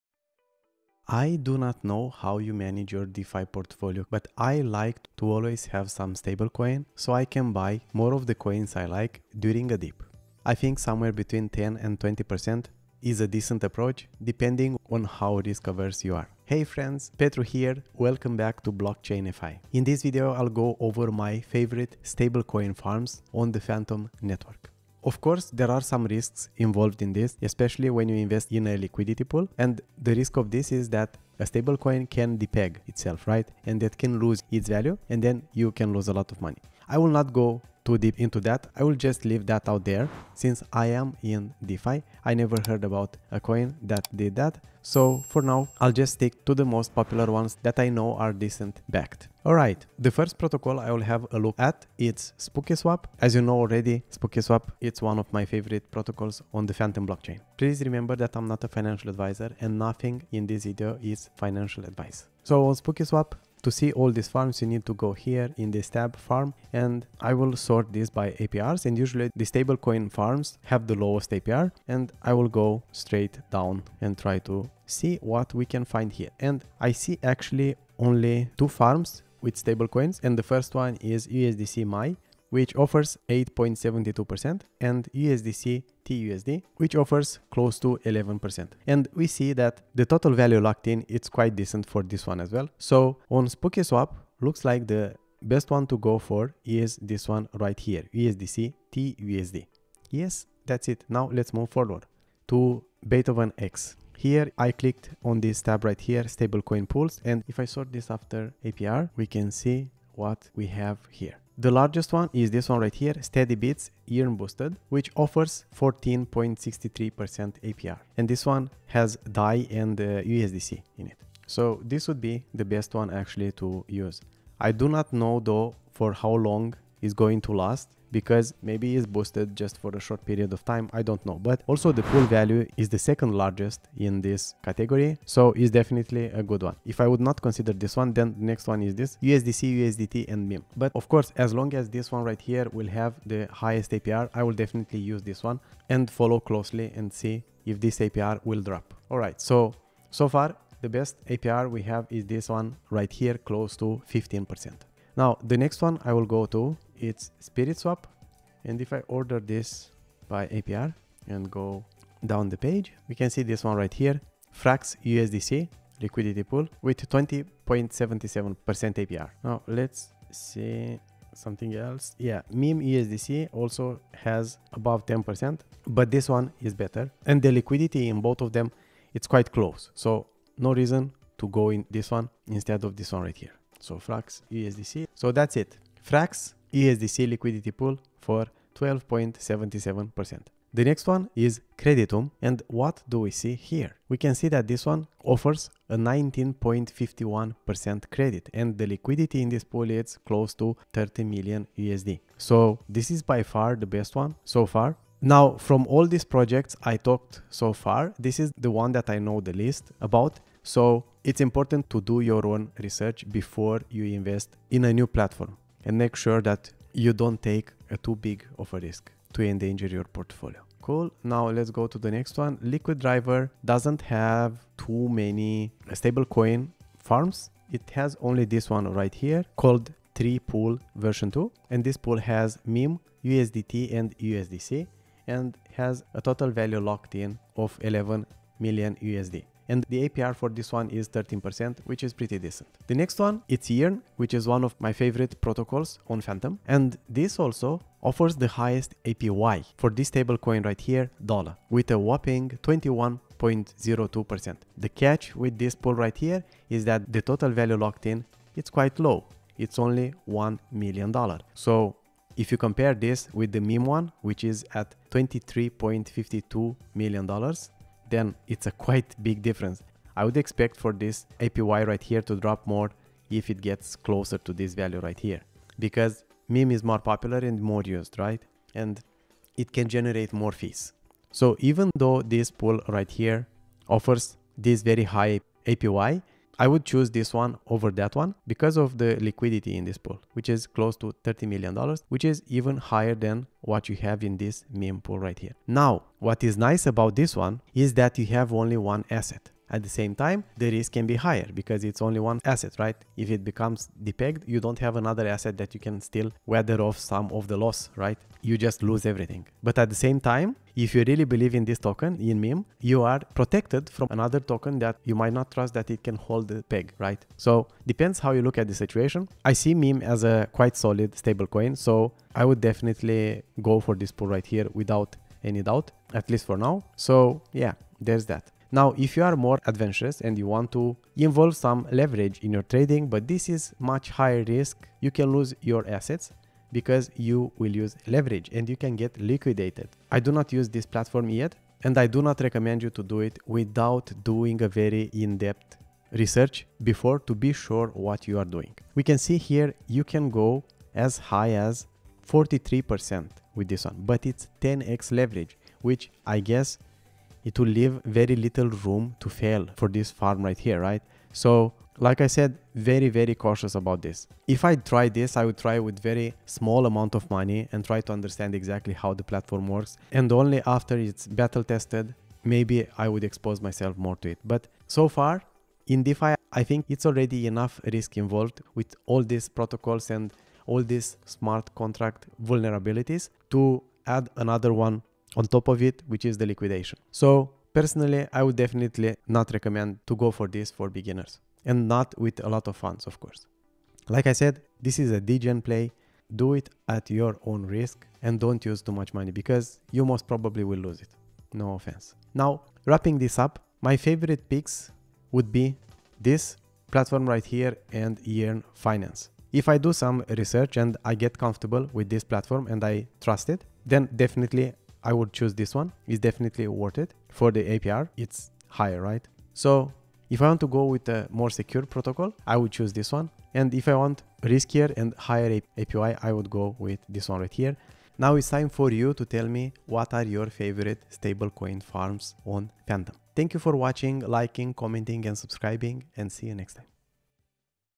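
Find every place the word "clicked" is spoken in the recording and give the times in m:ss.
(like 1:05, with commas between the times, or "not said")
1:44.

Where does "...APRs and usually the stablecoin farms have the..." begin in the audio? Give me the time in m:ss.
1:08.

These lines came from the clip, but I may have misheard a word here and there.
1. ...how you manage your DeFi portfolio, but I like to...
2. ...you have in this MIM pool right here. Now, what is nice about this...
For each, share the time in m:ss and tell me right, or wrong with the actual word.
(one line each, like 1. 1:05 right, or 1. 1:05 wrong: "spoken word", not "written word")
1. 0:02 right
2. 4:53 right.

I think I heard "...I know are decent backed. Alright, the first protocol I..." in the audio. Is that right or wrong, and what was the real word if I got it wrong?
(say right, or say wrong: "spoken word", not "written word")
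right.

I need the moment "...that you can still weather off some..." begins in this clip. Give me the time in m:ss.
5:05.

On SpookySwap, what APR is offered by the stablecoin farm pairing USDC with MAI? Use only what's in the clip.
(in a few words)
8.72%.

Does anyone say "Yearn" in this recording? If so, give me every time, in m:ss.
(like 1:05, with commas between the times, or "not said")
1:54, 4:03, 6:48.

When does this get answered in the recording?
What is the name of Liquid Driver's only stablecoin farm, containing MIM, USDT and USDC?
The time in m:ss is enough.
3:50.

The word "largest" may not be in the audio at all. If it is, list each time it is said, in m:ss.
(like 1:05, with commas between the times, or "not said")
1:51, 2:13.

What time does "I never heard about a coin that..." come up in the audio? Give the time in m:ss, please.
0:42.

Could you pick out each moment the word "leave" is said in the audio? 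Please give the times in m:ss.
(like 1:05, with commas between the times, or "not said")
0:39, 5:57.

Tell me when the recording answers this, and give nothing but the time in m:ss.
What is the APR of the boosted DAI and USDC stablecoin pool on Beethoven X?
1:55.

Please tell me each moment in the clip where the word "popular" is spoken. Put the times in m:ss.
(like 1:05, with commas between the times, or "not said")
0:46, 4:36.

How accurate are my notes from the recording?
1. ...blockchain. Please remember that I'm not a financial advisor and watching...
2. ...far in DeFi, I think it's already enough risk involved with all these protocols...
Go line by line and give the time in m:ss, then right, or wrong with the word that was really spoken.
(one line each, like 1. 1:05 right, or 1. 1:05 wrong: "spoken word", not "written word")
1. 0:57 wrong: "nothing", not "watching"
2. 6:15 right.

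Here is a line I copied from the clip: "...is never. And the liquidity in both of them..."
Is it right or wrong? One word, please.
wrong.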